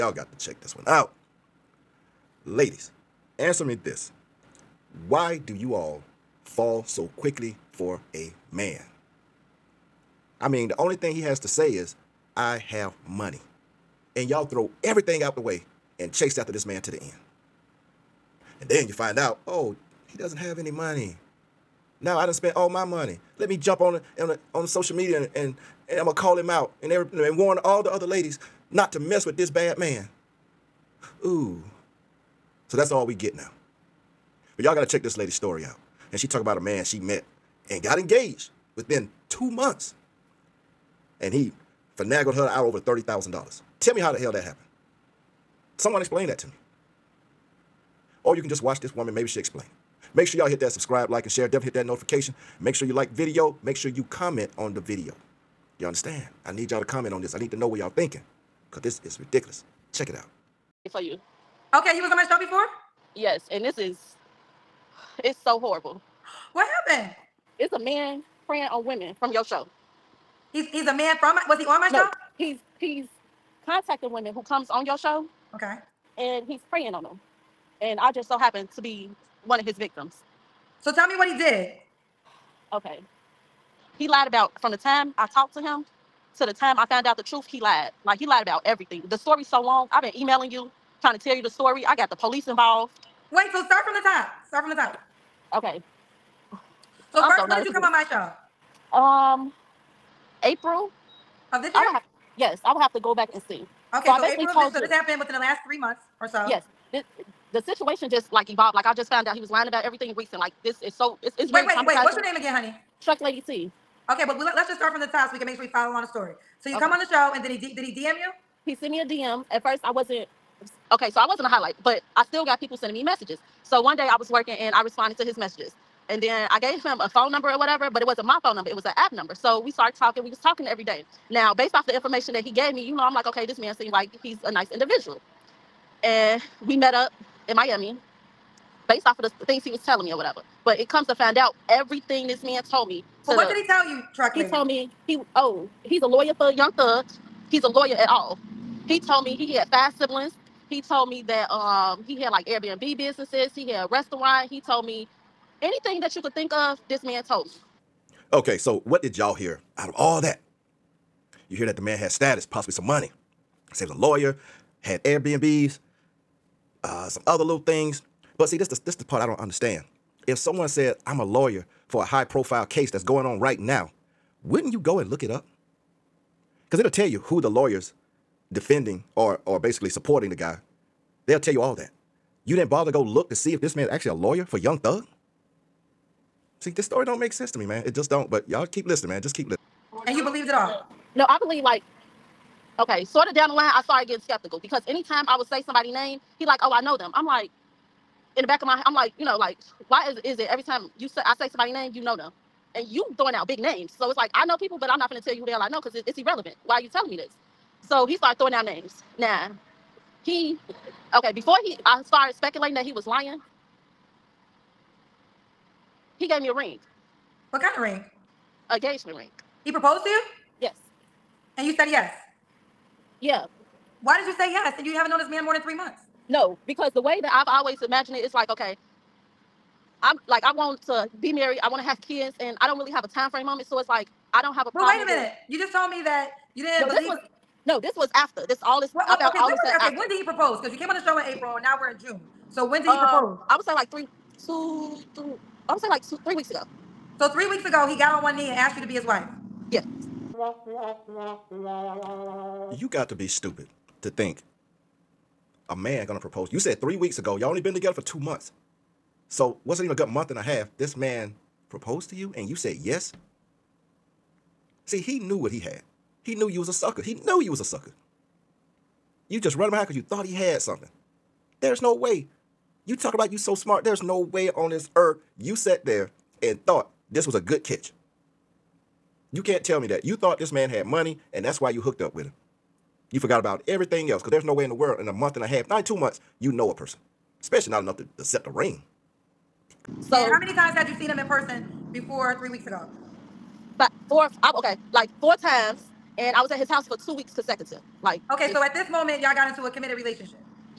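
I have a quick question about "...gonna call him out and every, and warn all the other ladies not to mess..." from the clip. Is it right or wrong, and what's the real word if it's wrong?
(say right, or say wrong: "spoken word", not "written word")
right.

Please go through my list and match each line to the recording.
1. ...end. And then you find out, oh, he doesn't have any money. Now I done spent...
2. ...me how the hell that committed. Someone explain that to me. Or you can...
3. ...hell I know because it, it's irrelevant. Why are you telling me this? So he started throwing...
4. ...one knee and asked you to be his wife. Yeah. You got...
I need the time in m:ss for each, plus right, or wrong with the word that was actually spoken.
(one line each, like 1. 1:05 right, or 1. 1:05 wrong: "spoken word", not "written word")
1. 0:16 right
2. 0:43 wrong: "happened", not "committed"
3. 3:25 right
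4. 4:08 right.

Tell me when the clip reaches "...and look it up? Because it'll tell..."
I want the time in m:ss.
2:54.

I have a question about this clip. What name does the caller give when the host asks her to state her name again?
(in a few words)
Truck Lady T.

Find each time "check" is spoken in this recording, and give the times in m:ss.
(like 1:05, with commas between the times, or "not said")
0:00, 0:34, 0:59.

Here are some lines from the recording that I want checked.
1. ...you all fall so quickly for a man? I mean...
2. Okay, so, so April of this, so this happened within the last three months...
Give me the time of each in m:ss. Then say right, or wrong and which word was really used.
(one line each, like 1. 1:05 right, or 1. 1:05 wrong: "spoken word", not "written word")
1. 0:05 right
2. 1:43 right.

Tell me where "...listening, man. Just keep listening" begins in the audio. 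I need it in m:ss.
3:08.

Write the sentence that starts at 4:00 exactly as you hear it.
Because you came on the show in April, now we're in June.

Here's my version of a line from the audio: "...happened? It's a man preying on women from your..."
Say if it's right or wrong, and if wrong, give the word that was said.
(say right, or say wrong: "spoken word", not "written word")
right.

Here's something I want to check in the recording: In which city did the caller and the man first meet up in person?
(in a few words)
Miami.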